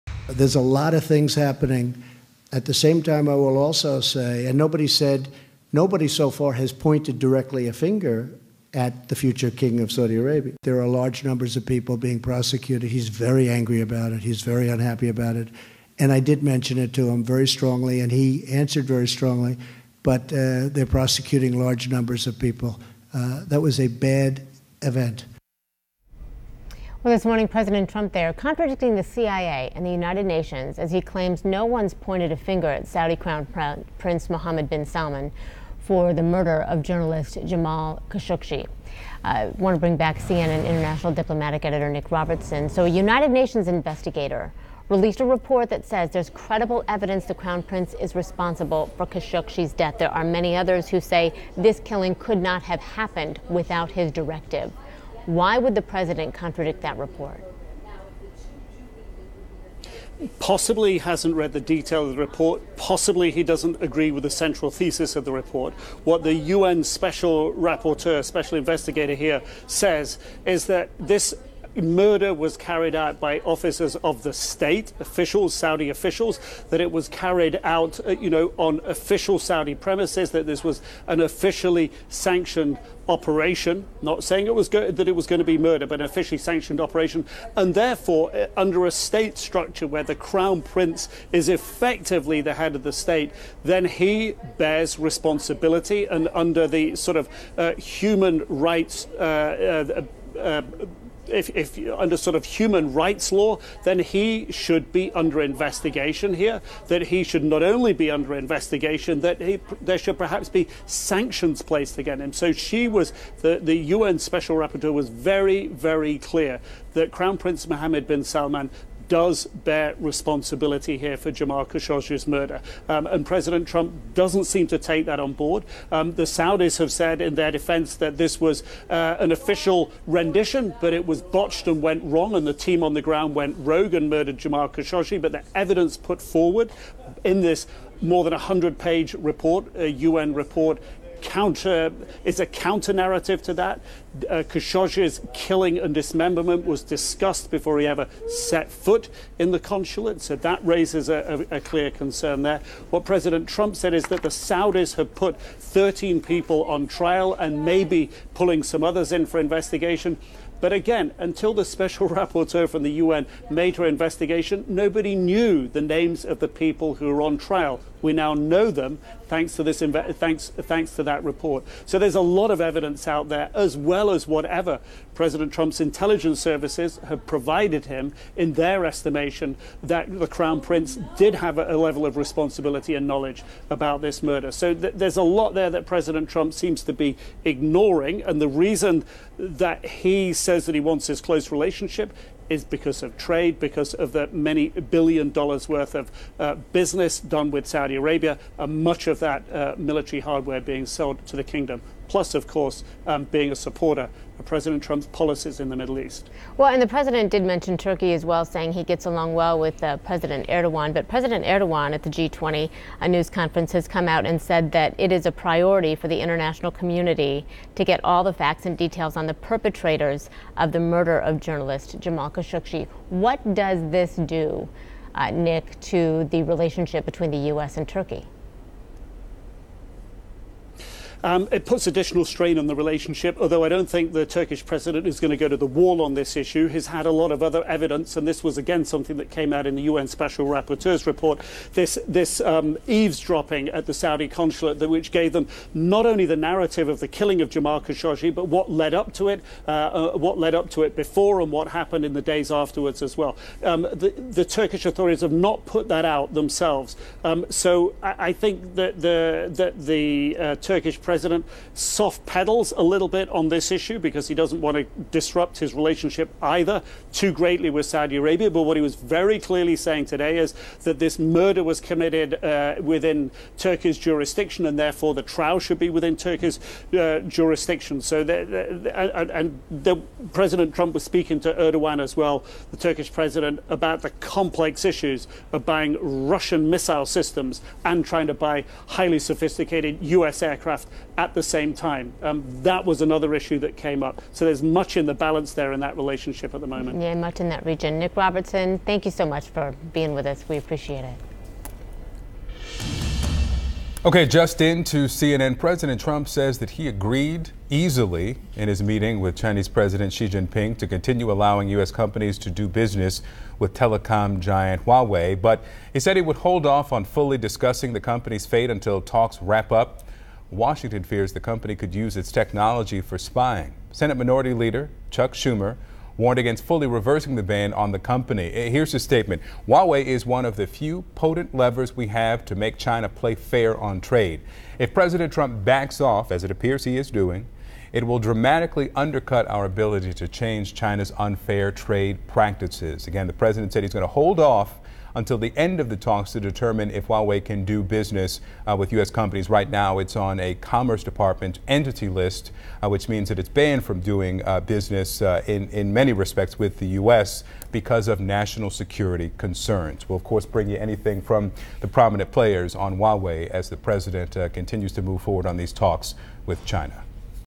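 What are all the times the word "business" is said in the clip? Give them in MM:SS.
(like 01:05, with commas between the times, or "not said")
03:16, 05:12, 05:47, 05:54.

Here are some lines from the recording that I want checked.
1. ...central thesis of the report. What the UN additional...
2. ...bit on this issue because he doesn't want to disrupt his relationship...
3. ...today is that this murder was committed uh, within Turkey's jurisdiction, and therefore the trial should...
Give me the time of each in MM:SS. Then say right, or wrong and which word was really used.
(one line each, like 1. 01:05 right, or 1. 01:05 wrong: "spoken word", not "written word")
1. 01:04 wrong: "special", not "additional"
2. 04:23 right
3. 04:30 right.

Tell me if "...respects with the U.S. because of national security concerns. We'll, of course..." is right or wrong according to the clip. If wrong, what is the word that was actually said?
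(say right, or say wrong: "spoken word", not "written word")
right.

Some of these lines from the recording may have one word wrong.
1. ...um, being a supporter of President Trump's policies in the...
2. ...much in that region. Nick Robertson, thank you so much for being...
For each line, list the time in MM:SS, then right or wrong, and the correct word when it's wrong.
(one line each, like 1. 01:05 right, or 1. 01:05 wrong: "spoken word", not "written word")
1. 03:23 right
2. 04:57 right.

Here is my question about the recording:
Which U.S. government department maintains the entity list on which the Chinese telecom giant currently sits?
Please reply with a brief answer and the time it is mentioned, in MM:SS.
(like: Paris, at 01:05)
Commerce Department, at 05:50.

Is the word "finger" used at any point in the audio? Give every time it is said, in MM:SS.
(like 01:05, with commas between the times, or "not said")
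00:07, 00:32.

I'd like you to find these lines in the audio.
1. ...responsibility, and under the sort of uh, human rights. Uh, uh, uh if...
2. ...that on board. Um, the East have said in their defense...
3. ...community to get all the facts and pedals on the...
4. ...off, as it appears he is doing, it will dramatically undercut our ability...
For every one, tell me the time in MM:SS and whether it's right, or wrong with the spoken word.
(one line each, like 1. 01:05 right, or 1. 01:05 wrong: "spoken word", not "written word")
1. 01:34 right
2. 02:05 wrong: "Saudis", not "East"
3. 03:36 wrong: "details", not "pedals"
4. 05:36 right.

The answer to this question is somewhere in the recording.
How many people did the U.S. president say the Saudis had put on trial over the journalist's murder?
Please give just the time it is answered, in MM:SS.
02:35.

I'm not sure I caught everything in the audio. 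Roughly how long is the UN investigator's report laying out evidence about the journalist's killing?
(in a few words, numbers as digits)
more than 100 pages.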